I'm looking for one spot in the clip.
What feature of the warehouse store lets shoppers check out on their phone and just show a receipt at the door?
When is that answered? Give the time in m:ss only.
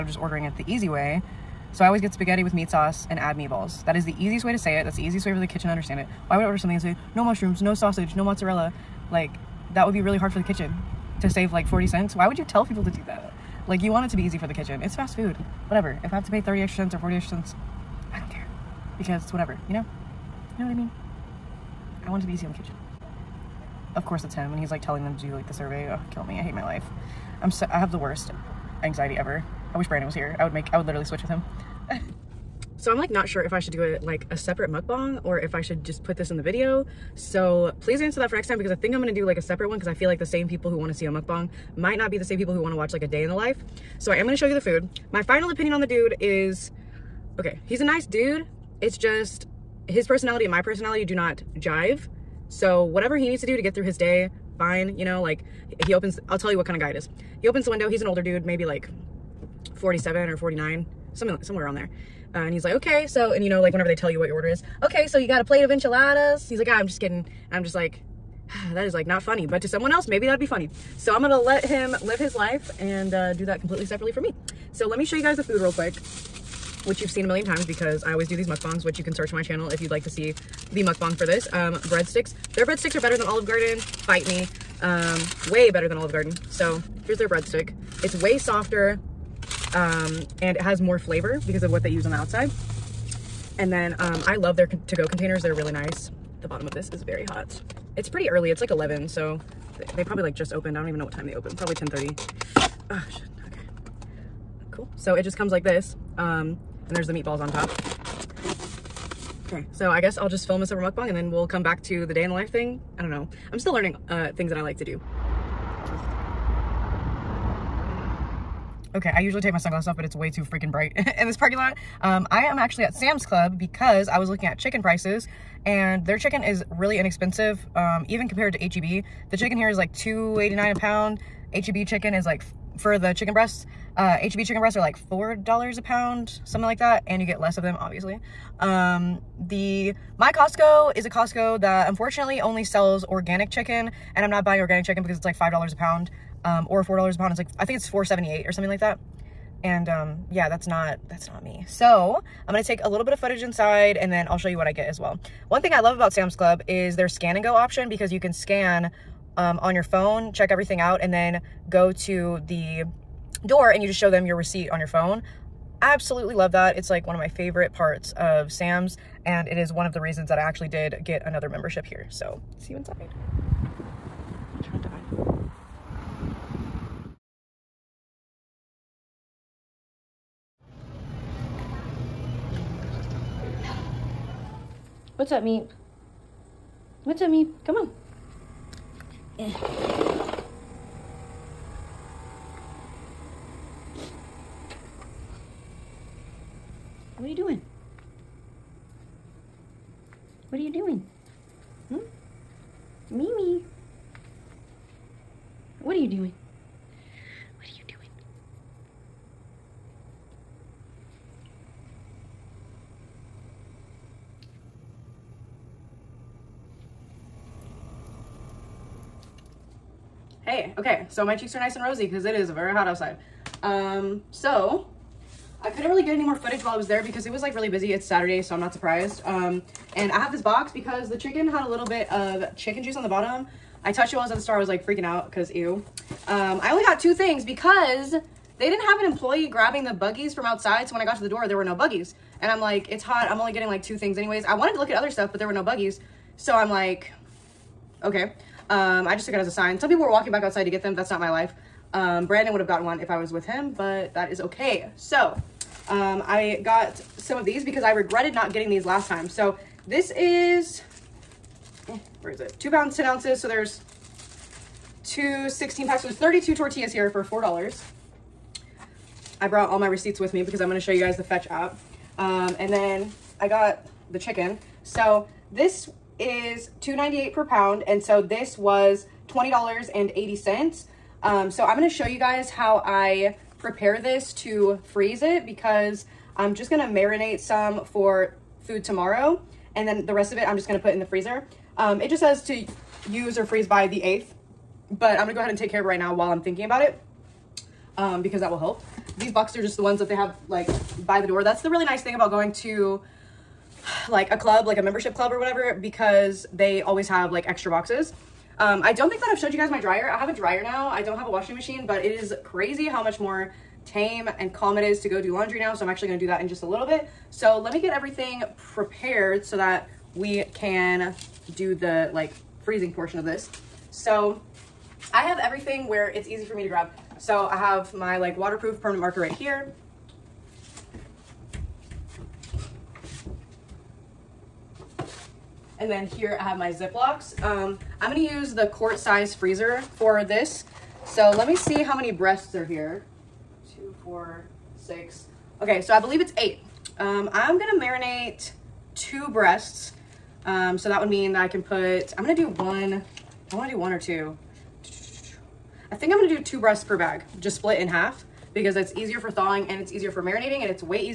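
2:37.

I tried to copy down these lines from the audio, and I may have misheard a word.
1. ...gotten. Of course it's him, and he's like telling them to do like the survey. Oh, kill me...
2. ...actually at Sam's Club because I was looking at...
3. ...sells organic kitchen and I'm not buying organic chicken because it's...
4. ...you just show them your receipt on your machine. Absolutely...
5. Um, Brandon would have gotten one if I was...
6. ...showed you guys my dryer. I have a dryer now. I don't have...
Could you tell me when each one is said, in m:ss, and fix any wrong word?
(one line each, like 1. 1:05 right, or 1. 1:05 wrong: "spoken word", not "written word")
1. 0:22 wrong: "kitchen", not "gotten"
2. 2:02 right
3. 2:22 wrong: "chicken", not "kitchen"
4. 2:43 wrong: "phone", not "machine"
5. 4:11 right
6. 5:09 right.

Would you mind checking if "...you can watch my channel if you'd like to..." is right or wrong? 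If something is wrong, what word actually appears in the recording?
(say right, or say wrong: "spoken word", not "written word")
wrong: "search", not "watch".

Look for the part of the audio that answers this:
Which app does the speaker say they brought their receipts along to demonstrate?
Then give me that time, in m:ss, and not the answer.
4:31.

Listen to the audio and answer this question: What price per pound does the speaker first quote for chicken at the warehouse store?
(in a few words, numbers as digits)
2.89.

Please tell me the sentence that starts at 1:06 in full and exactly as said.
He's like, ah, I'm just kidding.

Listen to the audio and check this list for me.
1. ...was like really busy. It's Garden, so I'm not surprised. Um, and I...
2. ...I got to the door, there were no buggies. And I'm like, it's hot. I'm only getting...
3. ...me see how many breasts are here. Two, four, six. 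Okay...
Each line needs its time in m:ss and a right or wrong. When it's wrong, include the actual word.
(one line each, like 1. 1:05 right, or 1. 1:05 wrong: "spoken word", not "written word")
1. 3:47 wrong: "Saturday", not "Garden"
2. 4:00 right
3. 5:41 right.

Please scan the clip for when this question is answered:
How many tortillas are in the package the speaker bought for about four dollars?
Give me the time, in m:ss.
4:26.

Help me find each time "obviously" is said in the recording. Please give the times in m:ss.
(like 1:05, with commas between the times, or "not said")
2:17.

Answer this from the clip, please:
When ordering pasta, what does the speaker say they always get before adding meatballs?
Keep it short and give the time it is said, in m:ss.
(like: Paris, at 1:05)
spaghetti with meat sauce, at 0:02.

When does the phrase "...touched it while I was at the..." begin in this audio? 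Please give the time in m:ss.
3:53.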